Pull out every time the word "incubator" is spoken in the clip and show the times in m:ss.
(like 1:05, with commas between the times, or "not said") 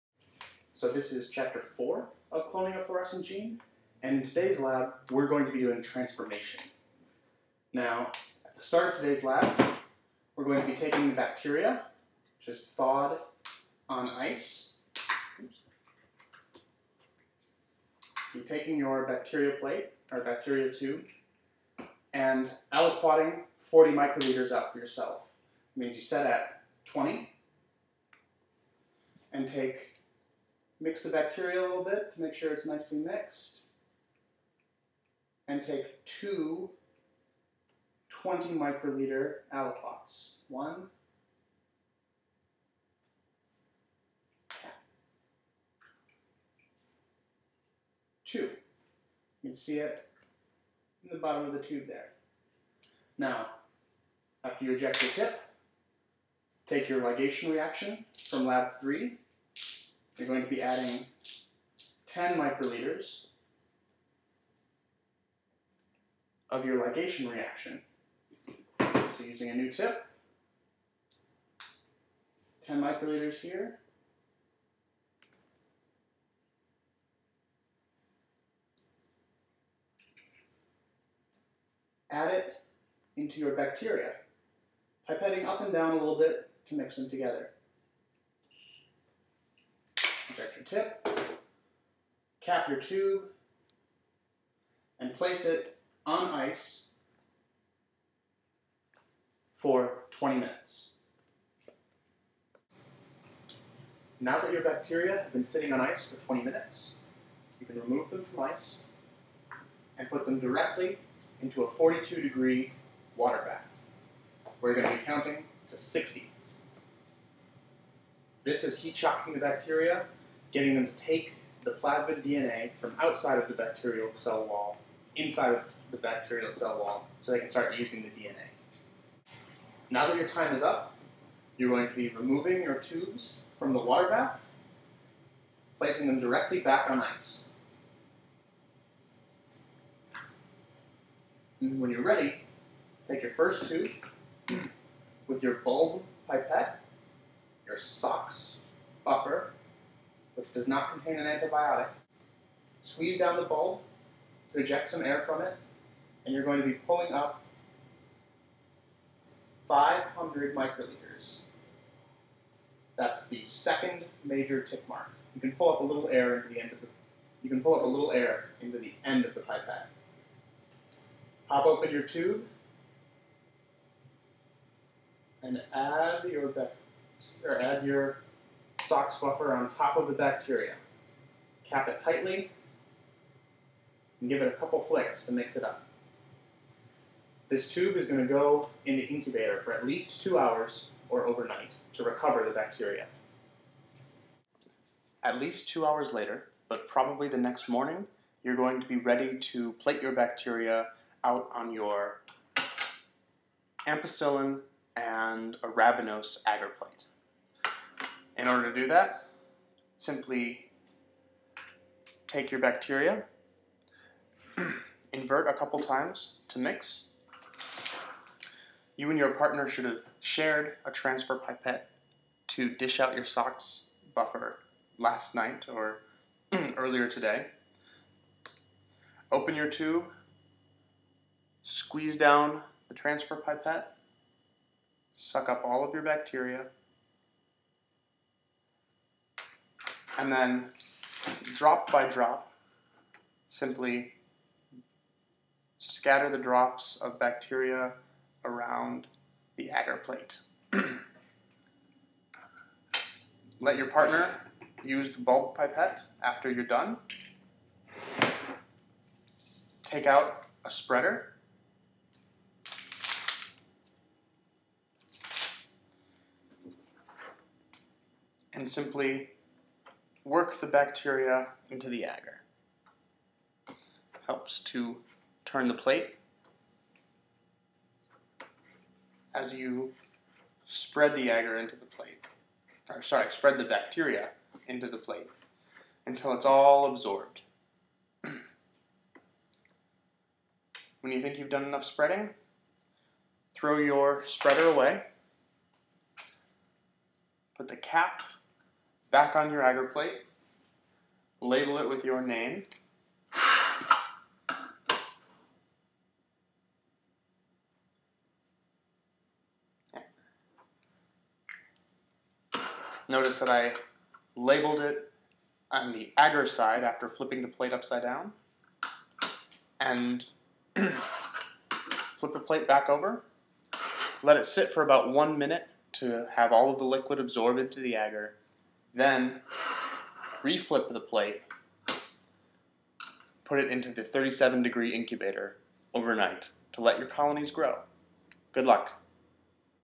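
3:09, 5:34.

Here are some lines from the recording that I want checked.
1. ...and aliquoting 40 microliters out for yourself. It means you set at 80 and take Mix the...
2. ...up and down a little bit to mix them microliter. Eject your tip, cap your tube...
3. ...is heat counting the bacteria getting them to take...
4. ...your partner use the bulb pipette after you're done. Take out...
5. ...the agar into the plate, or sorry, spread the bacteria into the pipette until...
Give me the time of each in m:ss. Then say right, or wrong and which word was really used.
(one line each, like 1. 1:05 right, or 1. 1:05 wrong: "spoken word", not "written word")
1. 0:22 wrong: "20", not "80"
2. 1:25 wrong: "together", not "microliter"
3. 1:58 wrong: "shocking", not "counting"
4. 4:13 right
5. 4:41 wrong: "plate", not "pipette".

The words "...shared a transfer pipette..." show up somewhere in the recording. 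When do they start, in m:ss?
3:40.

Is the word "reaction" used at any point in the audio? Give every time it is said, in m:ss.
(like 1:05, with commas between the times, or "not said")
0:57, 1:07.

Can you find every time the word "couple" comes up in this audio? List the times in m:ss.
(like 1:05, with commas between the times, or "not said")
3:04, 3:35.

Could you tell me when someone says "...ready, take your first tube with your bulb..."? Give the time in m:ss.
2:22.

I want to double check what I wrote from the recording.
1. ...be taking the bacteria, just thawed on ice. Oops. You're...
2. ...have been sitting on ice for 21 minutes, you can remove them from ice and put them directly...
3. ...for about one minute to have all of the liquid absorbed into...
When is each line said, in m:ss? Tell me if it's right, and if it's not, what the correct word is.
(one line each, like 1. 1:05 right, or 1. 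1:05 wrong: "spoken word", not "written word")
1. 0:10 right
2. 1:45 wrong: "20", not "21"
3. 5:24 right.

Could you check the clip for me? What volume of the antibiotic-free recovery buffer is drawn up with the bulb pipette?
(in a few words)
500 microliters.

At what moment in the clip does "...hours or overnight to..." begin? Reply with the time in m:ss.
3:10.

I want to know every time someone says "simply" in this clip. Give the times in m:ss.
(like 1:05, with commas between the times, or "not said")
3:29, 4:03, 4:28.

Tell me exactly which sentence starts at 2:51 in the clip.
Pop open your tube and add your or add your SOX buffer on top of the bacteria.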